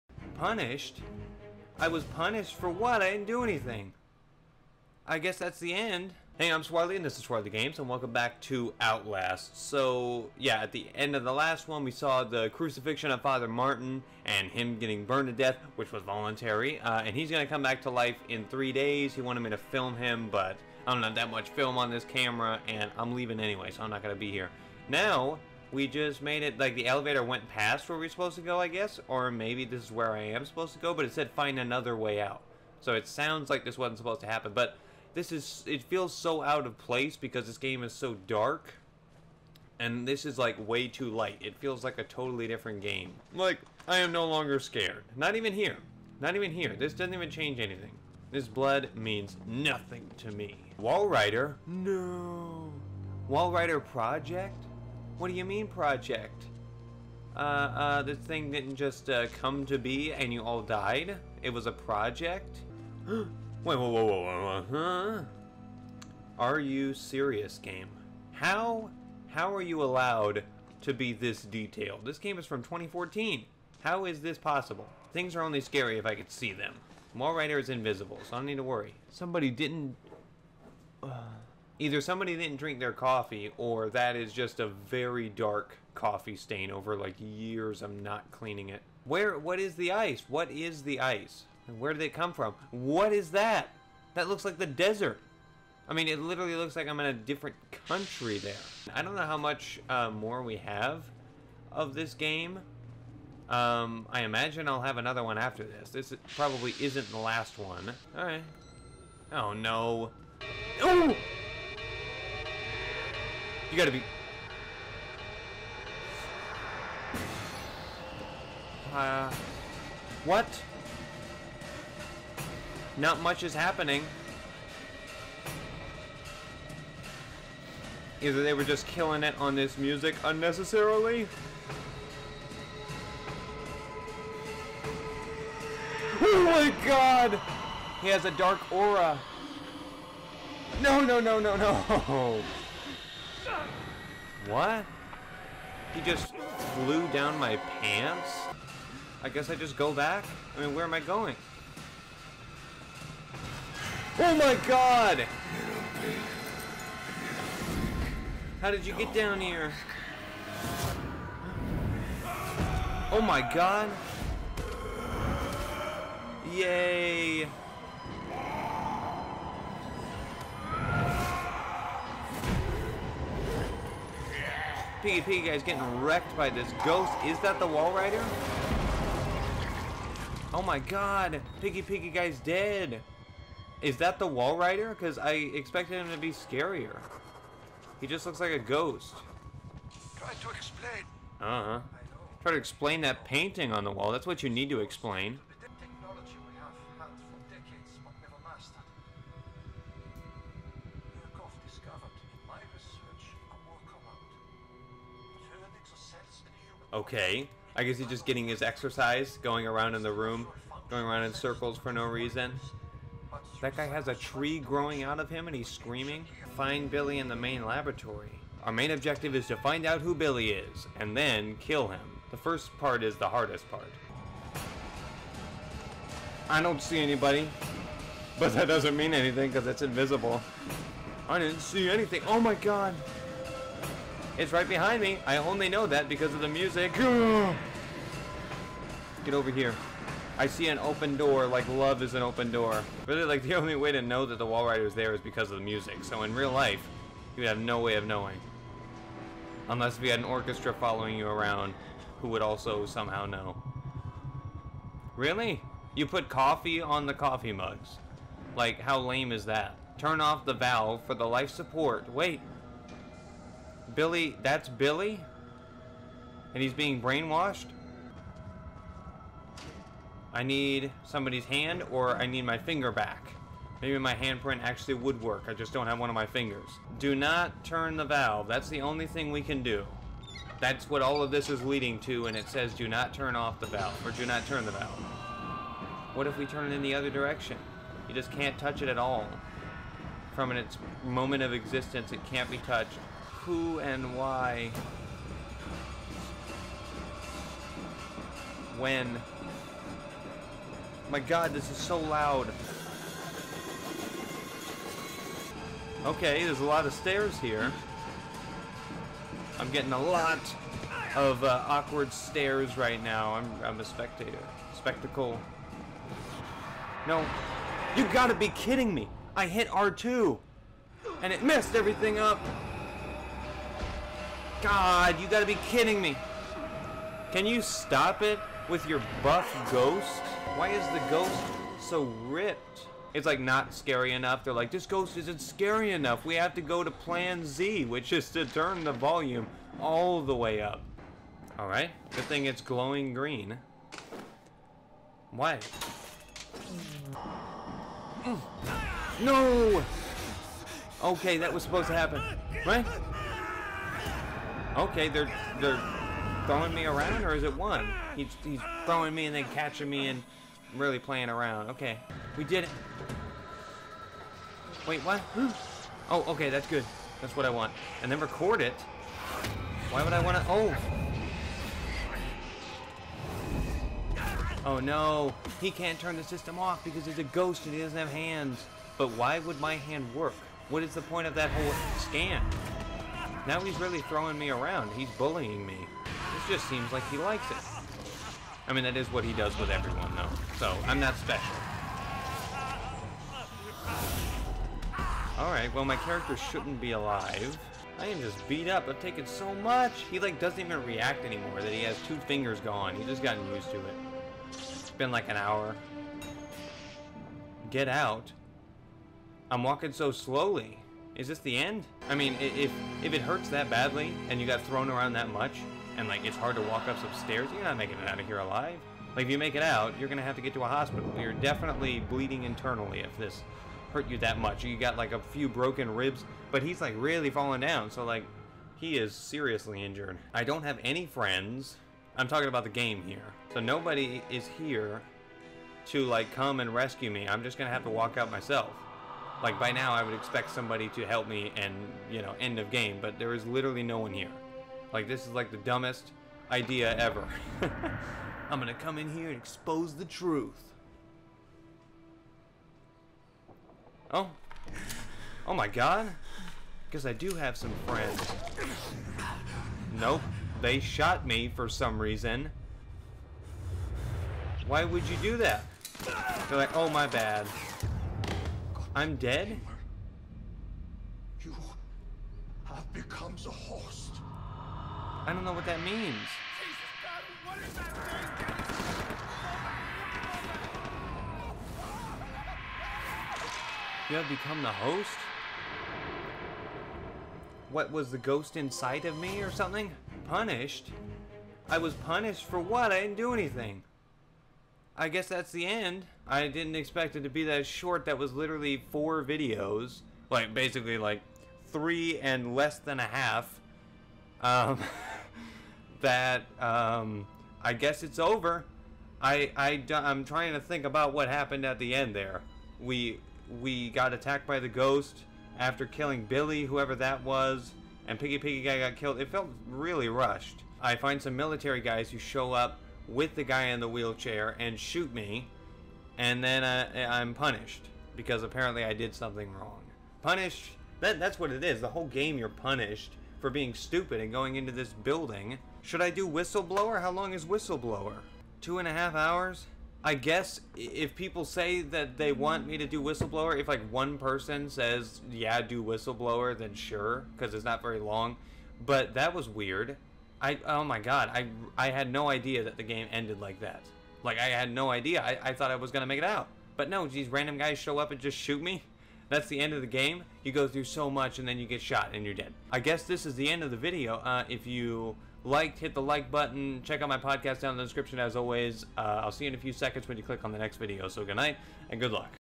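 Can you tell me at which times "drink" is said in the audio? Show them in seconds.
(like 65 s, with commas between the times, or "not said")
82 s.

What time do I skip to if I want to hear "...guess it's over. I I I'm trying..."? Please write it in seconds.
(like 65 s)
507 s.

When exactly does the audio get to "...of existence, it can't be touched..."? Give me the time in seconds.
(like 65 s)
291 s.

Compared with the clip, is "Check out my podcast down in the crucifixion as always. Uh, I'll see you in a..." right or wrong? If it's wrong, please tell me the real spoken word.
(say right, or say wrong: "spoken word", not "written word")
wrong: "description", not "crucifixion".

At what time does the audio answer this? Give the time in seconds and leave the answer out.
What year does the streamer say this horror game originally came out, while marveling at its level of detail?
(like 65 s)
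72 s.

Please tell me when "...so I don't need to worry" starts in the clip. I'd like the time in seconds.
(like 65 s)
78 s.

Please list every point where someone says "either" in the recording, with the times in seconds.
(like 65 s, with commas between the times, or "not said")
81 s, 128 s.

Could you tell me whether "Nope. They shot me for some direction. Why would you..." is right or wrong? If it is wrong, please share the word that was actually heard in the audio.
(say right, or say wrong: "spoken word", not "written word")
wrong: "reason", not "direction".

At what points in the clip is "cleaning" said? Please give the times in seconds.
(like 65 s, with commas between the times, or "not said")
88 s.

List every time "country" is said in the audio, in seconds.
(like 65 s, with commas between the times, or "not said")
97 s.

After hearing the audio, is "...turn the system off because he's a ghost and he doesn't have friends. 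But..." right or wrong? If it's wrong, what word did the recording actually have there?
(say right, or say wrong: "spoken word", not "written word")
wrong: "hands", not "friends".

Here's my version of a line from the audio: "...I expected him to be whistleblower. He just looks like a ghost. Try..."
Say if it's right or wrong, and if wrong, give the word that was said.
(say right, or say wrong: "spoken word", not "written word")
wrong: "scarier", not "whistleblower".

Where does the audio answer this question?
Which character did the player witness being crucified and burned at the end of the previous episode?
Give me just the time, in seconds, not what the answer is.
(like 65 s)
13 s.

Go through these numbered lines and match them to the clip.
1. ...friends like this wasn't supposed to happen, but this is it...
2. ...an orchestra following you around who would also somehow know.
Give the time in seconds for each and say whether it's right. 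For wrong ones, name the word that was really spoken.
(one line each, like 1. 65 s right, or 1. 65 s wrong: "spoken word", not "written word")
1. 33 s wrong: "sounds", not "friends"
2. 250 s right.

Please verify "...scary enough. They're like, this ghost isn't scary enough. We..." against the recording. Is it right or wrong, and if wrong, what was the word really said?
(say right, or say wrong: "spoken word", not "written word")
right.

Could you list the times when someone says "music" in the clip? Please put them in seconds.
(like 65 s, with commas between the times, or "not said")
129 s, 236 s, 245 s.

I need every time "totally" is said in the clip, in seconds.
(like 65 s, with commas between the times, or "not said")
42 s.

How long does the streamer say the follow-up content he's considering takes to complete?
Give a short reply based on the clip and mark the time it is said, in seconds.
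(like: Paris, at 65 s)
2.5 hours, at 538 s.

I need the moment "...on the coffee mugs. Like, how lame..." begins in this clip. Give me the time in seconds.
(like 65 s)
256 s.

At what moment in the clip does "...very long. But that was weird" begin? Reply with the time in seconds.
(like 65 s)
547 s.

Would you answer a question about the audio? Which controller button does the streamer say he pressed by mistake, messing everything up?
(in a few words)
R2.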